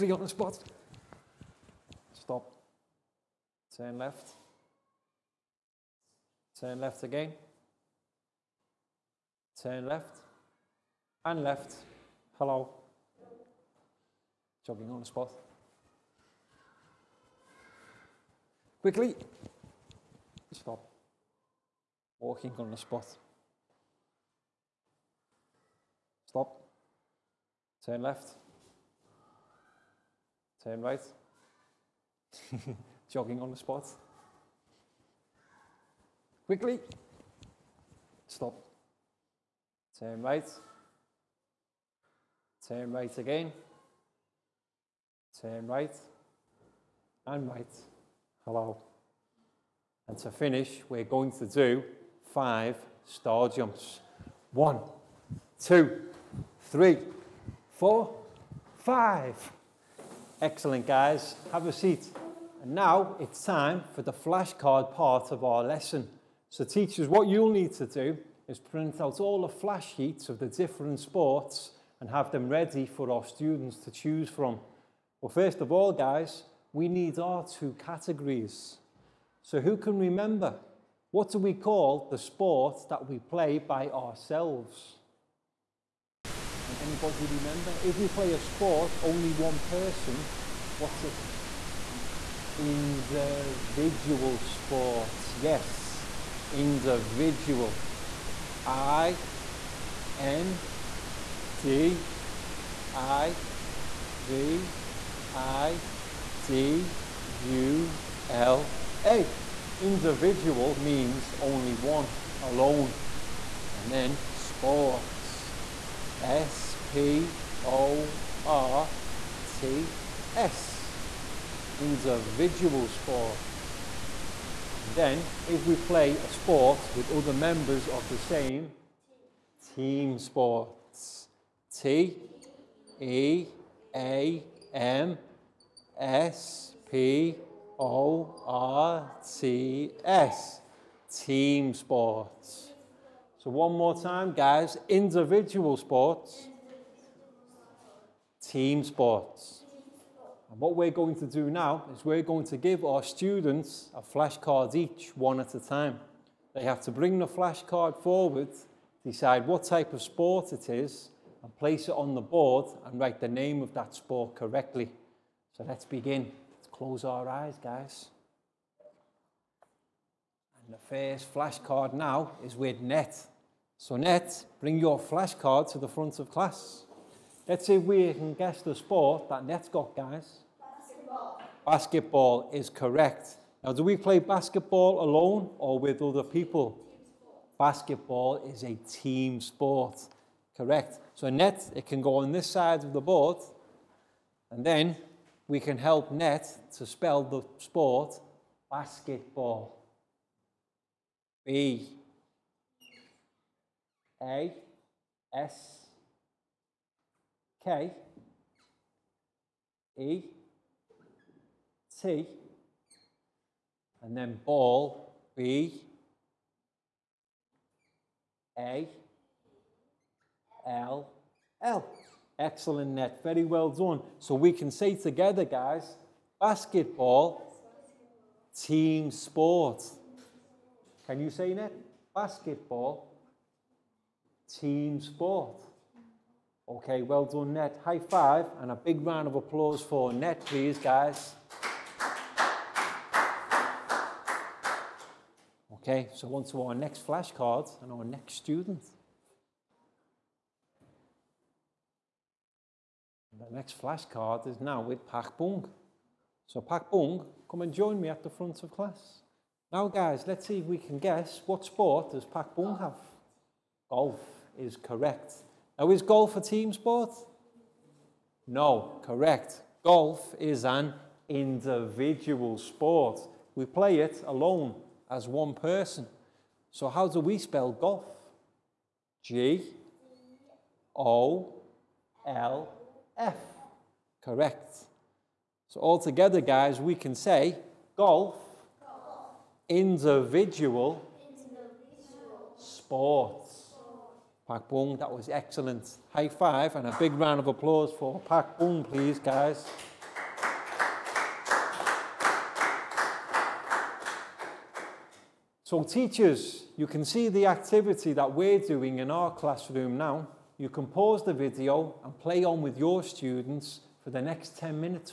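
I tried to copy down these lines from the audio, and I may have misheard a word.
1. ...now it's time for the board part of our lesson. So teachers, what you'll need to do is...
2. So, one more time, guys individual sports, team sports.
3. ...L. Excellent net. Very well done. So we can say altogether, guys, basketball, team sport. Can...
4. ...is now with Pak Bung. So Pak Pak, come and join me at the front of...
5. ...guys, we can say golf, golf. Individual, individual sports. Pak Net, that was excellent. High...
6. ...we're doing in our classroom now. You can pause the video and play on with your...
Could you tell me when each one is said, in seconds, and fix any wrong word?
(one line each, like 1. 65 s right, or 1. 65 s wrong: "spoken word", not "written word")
1. 62 s wrong: "flashcard", not "board"
2. 143 s right
3. 221 s wrong: "together", not "altogether"
4. 254 s wrong: "Bung", not "Pak"
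5. 286 s wrong: "Bung", not "Net"
6. 308 s right.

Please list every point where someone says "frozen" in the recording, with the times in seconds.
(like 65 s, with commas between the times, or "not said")
not said.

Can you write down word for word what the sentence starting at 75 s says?
Well, first of all, guys, we need our two categories.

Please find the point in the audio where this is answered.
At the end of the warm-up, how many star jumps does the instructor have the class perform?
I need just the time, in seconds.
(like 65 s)
52 s.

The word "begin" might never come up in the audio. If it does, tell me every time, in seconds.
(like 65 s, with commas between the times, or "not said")
165 s.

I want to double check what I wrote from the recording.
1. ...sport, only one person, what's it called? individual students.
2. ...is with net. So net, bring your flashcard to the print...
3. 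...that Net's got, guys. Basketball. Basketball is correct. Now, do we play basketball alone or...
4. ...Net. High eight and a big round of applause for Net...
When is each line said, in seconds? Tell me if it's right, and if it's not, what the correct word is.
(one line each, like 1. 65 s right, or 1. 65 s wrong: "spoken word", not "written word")
1. 88 s wrong: "sports", not "students"
2. 172 s wrong: "front", not "print"
3. 179 s right
4. 237 s wrong: "five", not "eight".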